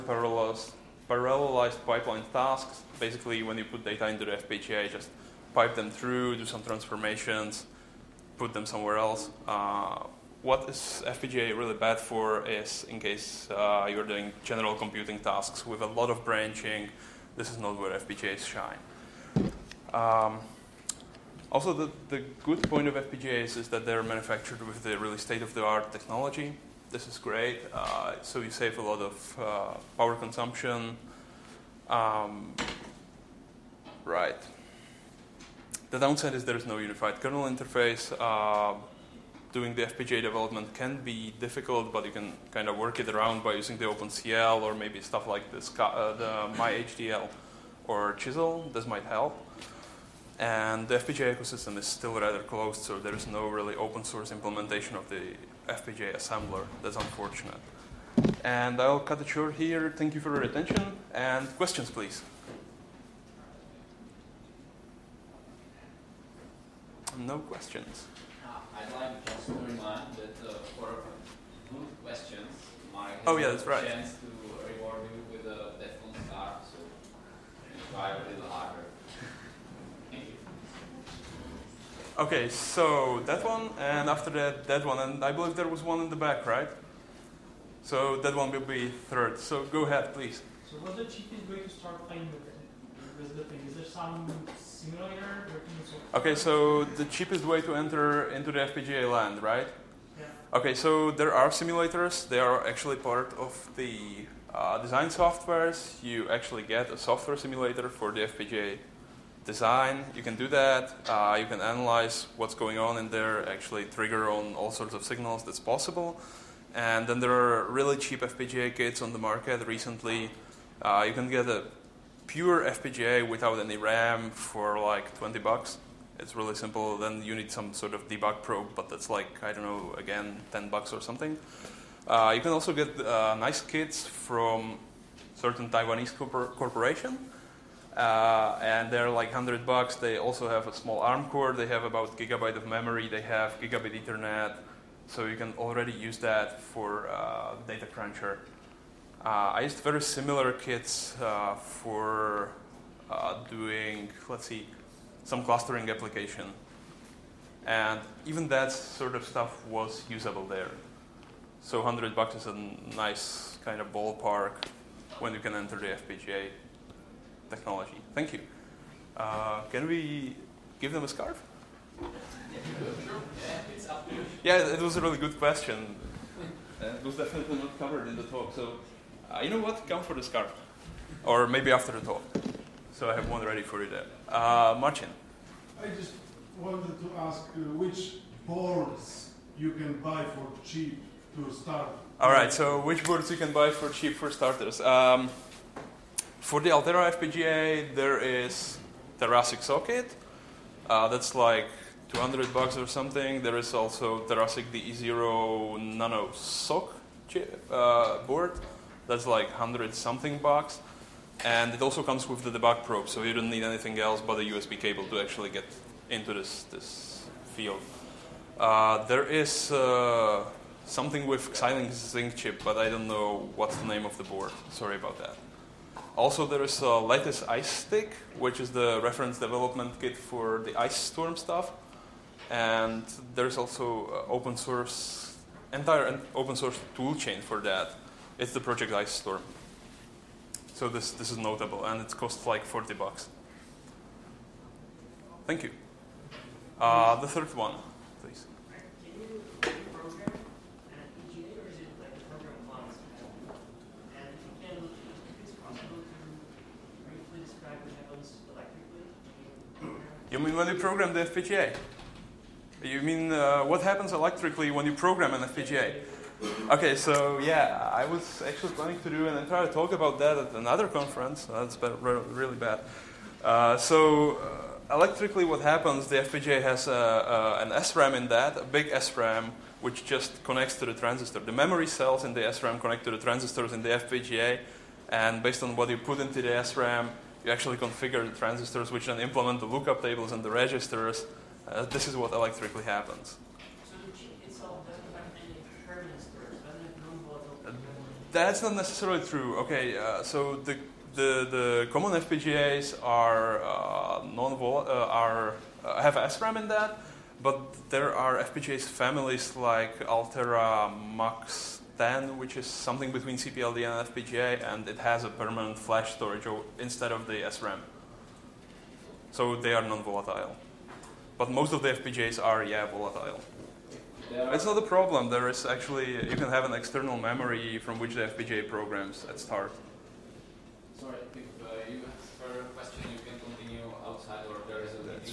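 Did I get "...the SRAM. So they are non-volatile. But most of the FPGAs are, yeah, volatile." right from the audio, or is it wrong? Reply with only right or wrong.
right.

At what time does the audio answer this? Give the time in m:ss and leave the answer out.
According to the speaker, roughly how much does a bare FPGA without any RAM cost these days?
2:05.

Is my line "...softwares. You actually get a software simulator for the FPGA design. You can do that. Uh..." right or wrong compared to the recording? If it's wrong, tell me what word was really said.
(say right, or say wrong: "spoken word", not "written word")
right.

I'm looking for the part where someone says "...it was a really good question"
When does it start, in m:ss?
2:54.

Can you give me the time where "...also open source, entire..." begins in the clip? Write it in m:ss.
3:53.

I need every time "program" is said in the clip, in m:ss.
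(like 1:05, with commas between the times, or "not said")
4:20, 4:24, 5:28.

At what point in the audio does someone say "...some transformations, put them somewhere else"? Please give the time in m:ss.
0:06.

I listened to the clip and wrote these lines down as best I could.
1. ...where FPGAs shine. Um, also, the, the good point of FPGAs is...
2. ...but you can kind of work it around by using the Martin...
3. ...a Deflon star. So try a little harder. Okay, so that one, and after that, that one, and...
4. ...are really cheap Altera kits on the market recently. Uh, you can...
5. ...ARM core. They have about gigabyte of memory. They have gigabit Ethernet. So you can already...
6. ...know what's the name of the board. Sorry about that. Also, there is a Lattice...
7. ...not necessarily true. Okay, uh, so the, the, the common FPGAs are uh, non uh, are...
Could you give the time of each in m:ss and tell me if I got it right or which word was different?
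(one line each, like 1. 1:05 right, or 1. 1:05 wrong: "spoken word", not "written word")
1. 0:17 right
2. 0:41 wrong: "OpenCL", not "Martin"
3. 1:15 right
4. 1:57 wrong: "FPGA", not "Altera"
5. 2:20 right
6. 3:43 right
7. 4:58 right.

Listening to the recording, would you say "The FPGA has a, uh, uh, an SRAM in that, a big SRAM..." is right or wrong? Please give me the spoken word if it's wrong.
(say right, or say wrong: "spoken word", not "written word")
right.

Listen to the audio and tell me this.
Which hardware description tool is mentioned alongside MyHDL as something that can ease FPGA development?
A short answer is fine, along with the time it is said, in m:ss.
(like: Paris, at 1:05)
Chisel, at 0:48.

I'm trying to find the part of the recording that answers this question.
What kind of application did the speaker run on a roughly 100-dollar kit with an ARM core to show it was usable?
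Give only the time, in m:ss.
2:35.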